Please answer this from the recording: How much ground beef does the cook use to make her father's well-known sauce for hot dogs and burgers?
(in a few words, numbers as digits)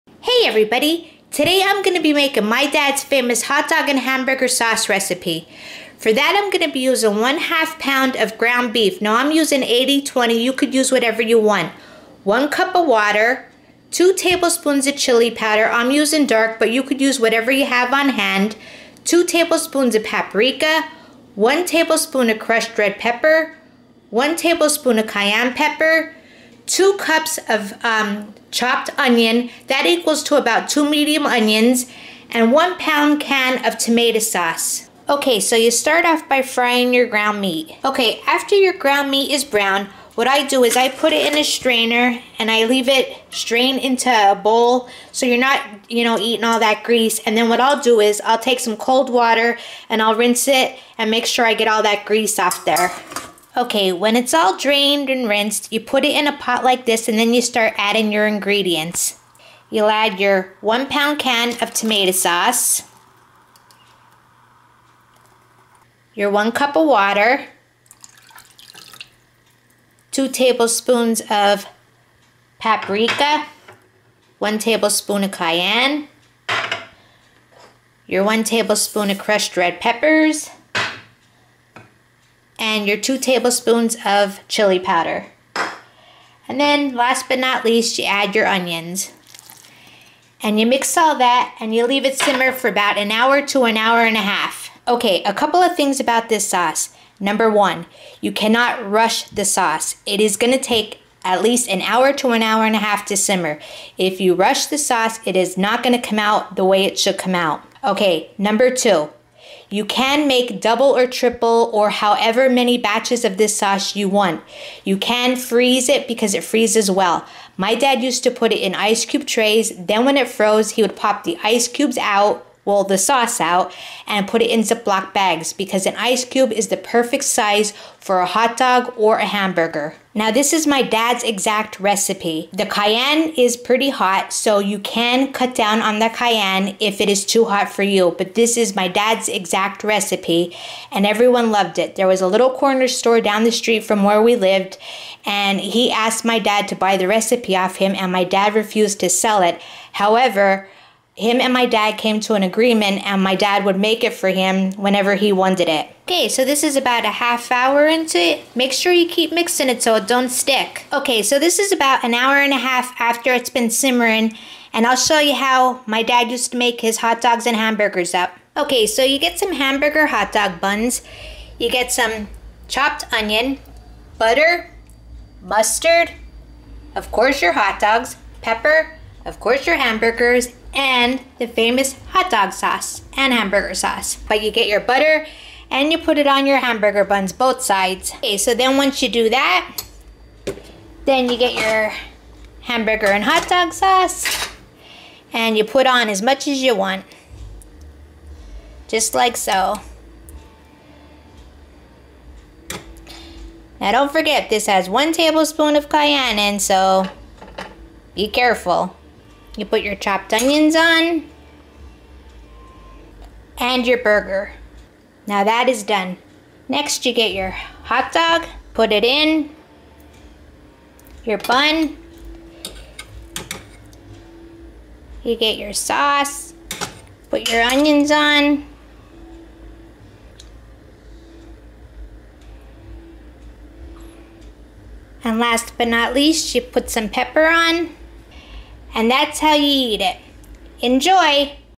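1/2 pound.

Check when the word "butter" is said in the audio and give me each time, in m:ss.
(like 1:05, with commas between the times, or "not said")
2:54, 3:04.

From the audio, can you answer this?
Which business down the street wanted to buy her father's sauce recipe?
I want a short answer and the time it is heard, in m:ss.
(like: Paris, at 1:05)
Corner store, at 2:22.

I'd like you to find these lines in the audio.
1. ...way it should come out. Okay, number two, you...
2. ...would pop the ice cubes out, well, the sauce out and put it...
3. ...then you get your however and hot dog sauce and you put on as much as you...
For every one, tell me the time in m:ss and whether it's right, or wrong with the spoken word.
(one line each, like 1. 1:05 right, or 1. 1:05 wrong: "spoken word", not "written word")
1. 1:46 right
2. 2:00 right
3. 3:11 wrong: "hamburger", not "however".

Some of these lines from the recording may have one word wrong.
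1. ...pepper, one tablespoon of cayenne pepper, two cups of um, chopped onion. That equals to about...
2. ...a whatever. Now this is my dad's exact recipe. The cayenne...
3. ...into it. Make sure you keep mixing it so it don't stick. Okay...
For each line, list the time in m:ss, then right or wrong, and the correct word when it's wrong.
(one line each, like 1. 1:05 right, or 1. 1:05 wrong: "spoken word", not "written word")
1. 0:22 right
2. 2:09 wrong: "hamburger", not "whatever"
3. 2:37 right.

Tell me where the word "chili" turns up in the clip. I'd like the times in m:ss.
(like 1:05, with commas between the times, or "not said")
0:14, 1:24.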